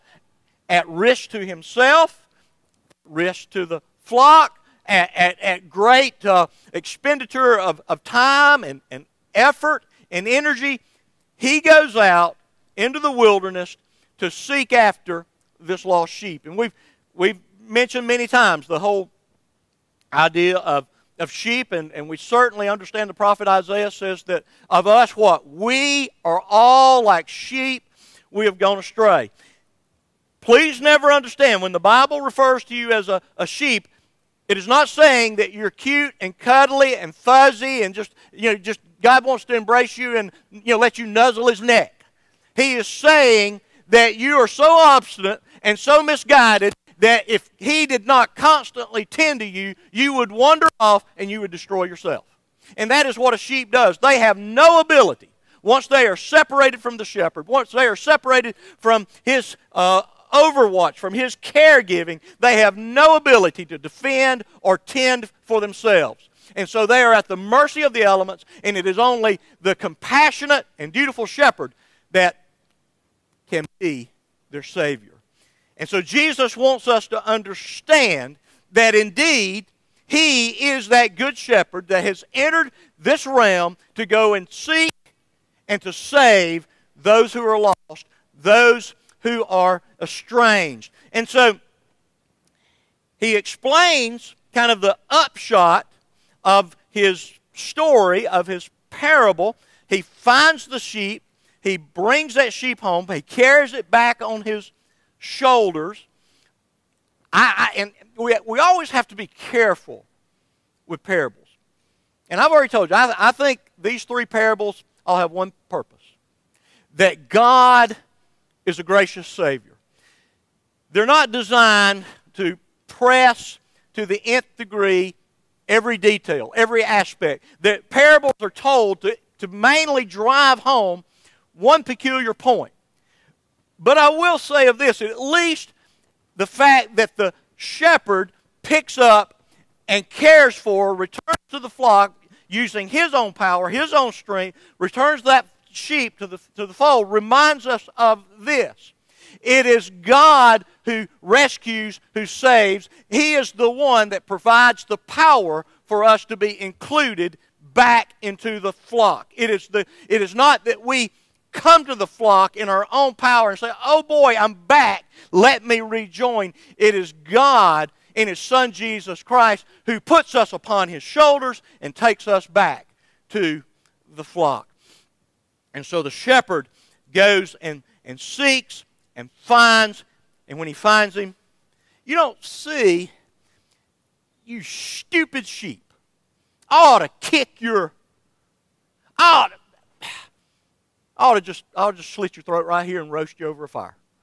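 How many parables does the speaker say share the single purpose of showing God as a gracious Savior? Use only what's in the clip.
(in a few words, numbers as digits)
3.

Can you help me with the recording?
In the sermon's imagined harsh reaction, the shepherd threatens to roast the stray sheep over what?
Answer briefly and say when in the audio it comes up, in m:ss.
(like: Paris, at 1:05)
a fire, at 3:13.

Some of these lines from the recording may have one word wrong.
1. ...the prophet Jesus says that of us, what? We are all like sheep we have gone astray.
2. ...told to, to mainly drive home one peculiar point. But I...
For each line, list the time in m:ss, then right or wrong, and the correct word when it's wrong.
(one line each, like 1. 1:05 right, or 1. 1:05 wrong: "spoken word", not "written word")
1. 0:23 wrong: "Isaiah", not "Jesus"
2. 2:08 right.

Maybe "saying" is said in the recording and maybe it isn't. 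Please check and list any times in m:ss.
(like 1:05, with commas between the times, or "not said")
0:34, 0:42.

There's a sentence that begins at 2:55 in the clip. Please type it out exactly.
And so the shepherd goes and, and seeks and finds, and when he finds him, you don't see, you stupid sheep.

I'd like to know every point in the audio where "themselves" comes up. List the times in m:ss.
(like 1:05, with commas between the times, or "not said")
1:05.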